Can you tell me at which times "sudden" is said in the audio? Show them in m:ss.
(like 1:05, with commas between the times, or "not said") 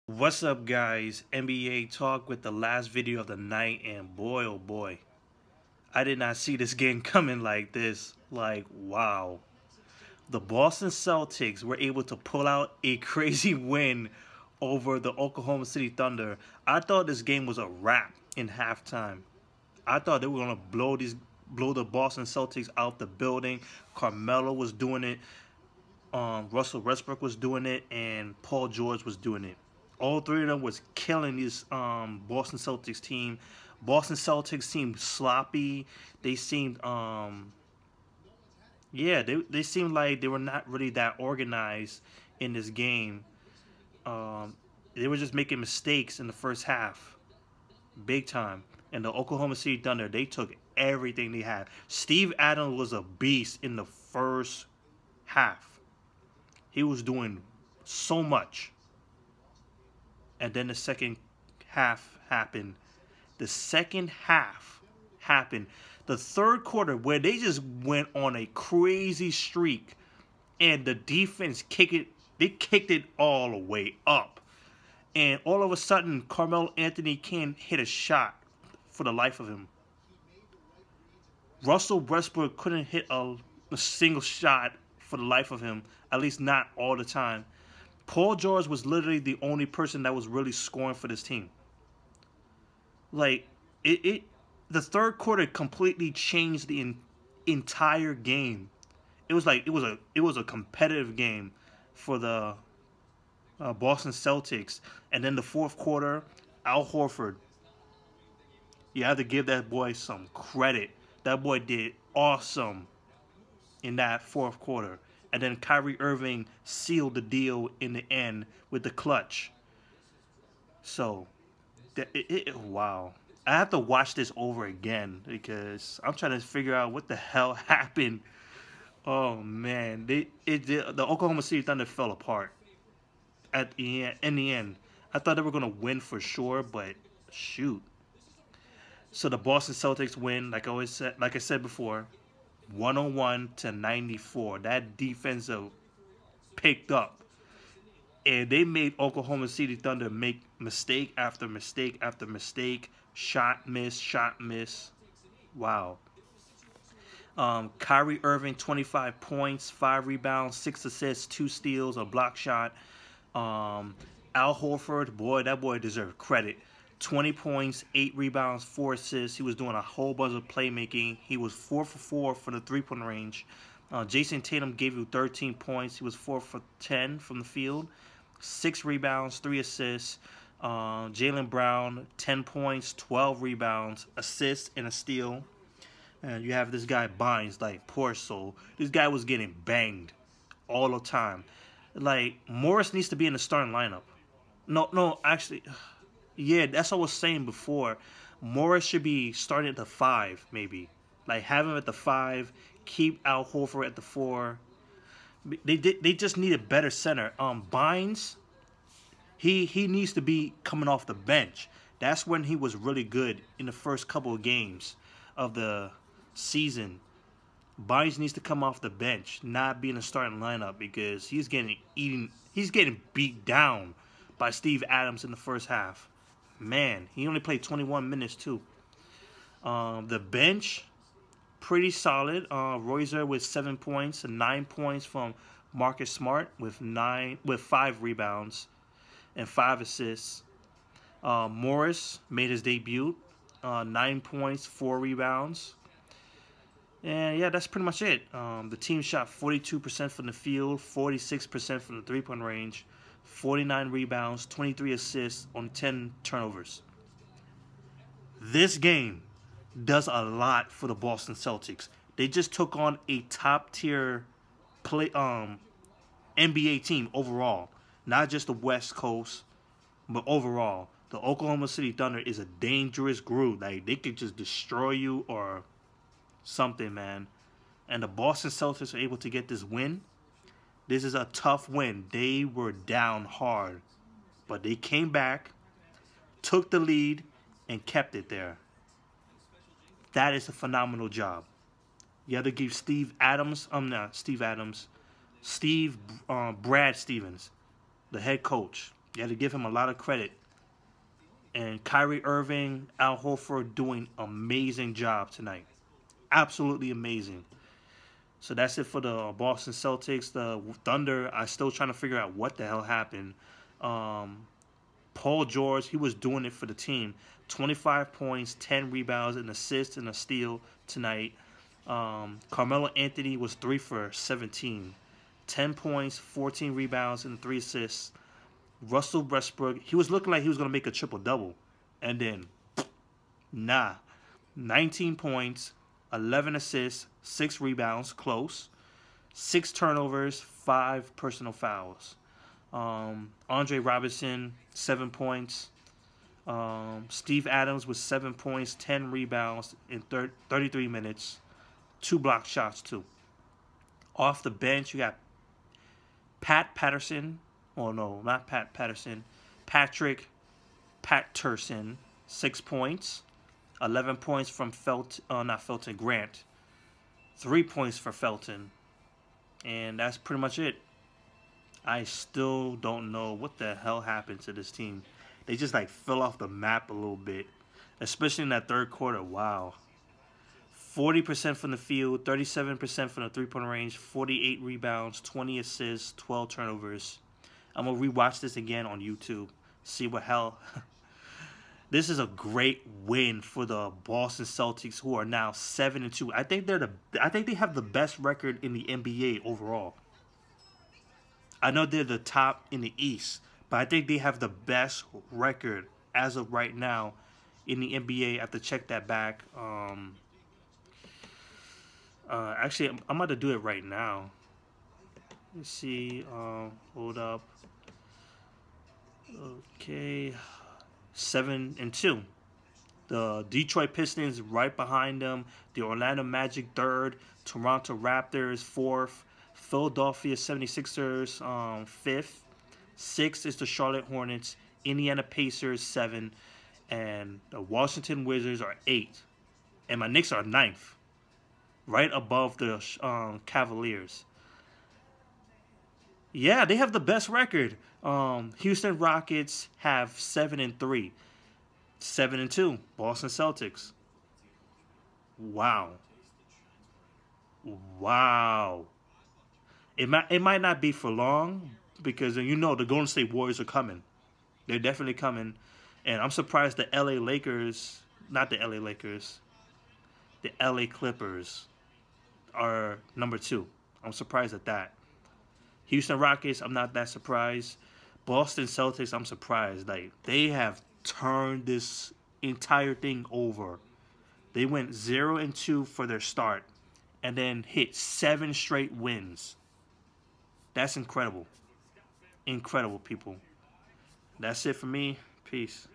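1:15.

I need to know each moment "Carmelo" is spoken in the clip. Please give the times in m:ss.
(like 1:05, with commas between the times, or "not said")
0:23, 1:16, 5:22.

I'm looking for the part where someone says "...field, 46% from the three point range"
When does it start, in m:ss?
4:10.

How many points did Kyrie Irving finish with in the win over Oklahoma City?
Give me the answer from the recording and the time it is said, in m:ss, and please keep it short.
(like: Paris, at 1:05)
25, at 2:38.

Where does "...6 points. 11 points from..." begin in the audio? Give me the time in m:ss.
6:02.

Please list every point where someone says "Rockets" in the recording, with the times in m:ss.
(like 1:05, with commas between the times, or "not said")
7:28, 7:56.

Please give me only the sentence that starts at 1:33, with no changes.
Like it, it the third quarter completely changed the in, entire game.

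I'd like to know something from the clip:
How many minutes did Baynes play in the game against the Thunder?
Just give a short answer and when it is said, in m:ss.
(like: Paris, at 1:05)
21, at 3:47.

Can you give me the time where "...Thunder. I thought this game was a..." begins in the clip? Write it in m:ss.
0:15.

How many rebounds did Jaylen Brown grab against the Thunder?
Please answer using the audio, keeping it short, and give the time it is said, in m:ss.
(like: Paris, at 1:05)
12, at 3:02.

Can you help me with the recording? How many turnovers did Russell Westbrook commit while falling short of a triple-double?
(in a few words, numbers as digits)
6.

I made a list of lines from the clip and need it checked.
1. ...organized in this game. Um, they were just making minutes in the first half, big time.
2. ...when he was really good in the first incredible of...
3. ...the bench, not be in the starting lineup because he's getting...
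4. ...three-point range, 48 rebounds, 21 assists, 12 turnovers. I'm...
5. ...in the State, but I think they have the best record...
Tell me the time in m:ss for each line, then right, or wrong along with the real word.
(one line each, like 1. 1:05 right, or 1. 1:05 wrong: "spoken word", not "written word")
1. 0:41 wrong: "mistakes", not "minutes"
2. 3:32 wrong: "couple", not "incredible"
3. 3:38 right
4. 6:23 wrong: "20", not "21"
5. 6:42 wrong: "East", not "State".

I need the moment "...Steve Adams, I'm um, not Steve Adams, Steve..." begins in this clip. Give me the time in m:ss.
4:52.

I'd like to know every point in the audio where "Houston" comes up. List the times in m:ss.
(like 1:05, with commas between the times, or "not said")
7:28, 7:55.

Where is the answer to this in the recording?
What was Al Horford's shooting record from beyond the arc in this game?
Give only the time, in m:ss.
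2:51.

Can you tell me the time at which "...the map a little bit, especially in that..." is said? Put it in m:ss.
6:16.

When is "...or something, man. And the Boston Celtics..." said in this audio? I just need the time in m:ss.
4:35.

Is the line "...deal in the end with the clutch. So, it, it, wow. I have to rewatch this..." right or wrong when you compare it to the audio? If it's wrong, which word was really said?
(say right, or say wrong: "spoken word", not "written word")
wrong: "watch", not "rewatch".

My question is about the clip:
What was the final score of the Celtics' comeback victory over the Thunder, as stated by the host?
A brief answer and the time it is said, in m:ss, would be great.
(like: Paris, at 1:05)
101 to 94, at 2:22.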